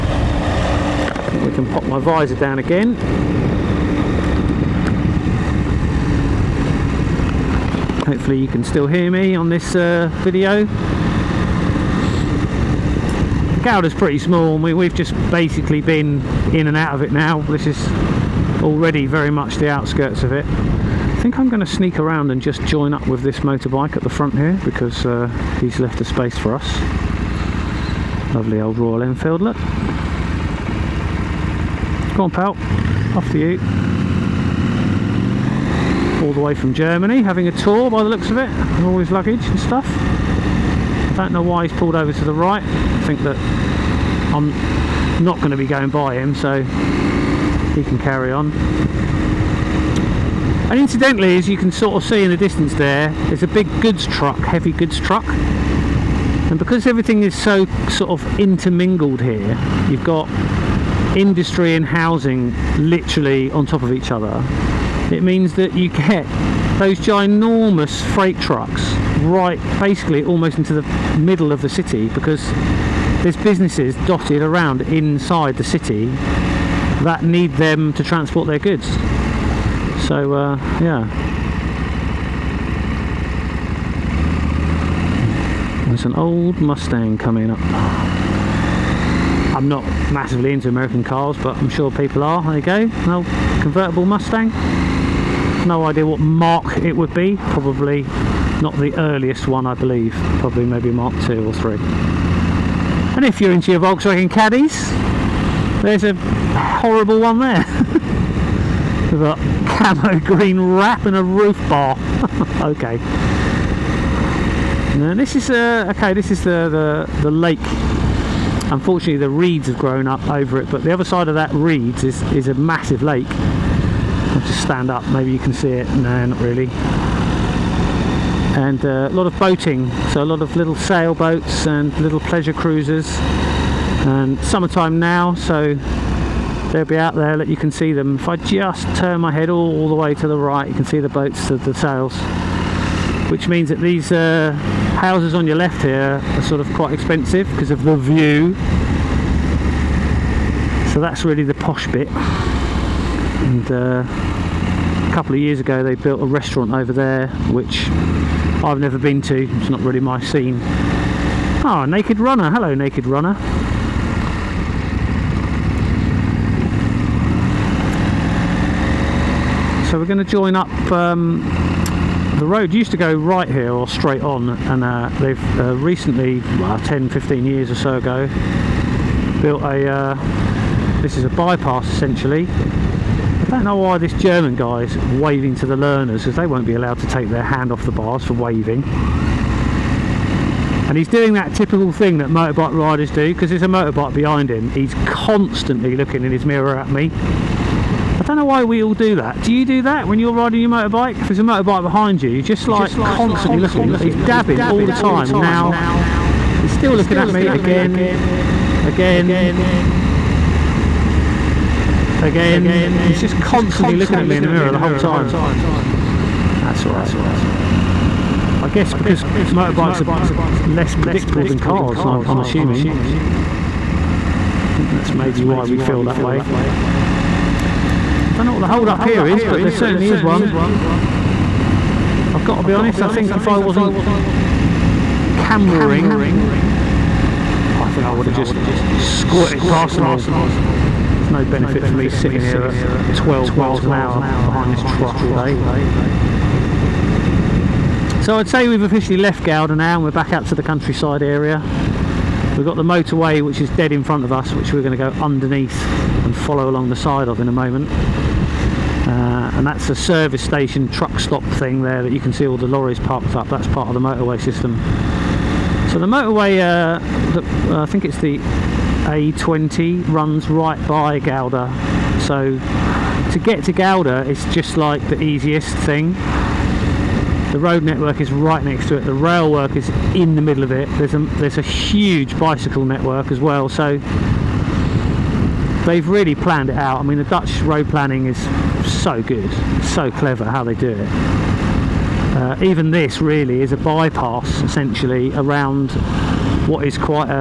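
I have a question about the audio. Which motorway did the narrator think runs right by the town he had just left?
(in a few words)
A20.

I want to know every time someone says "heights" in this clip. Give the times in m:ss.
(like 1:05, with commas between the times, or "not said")
not said.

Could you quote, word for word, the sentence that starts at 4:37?
The road network is right next to it.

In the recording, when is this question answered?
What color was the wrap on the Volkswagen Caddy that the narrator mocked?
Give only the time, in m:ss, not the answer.
1:49.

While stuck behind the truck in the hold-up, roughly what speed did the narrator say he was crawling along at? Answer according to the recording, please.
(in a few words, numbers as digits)
12 miles an hour.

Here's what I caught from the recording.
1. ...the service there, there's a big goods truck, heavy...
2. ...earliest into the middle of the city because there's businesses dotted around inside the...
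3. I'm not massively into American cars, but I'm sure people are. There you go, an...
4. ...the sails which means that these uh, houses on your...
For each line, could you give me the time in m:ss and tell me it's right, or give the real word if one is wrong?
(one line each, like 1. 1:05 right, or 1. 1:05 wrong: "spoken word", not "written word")
1. 0:52 wrong: "distance", not "service"
2. 1:10 wrong: "almost", not "earliest"
3. 1:29 right
4. 2:21 right.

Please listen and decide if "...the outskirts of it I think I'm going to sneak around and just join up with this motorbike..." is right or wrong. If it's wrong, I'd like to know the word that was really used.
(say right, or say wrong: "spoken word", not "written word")
right.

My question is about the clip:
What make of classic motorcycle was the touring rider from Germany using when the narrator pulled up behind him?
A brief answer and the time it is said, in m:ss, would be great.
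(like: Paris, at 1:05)
Royal Enfield, at 0:28.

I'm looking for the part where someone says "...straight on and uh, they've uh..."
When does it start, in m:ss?
2:53.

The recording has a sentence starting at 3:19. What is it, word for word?
Do you do that when you're riding your motorbike?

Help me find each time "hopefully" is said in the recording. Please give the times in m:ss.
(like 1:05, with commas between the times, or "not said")
0:08.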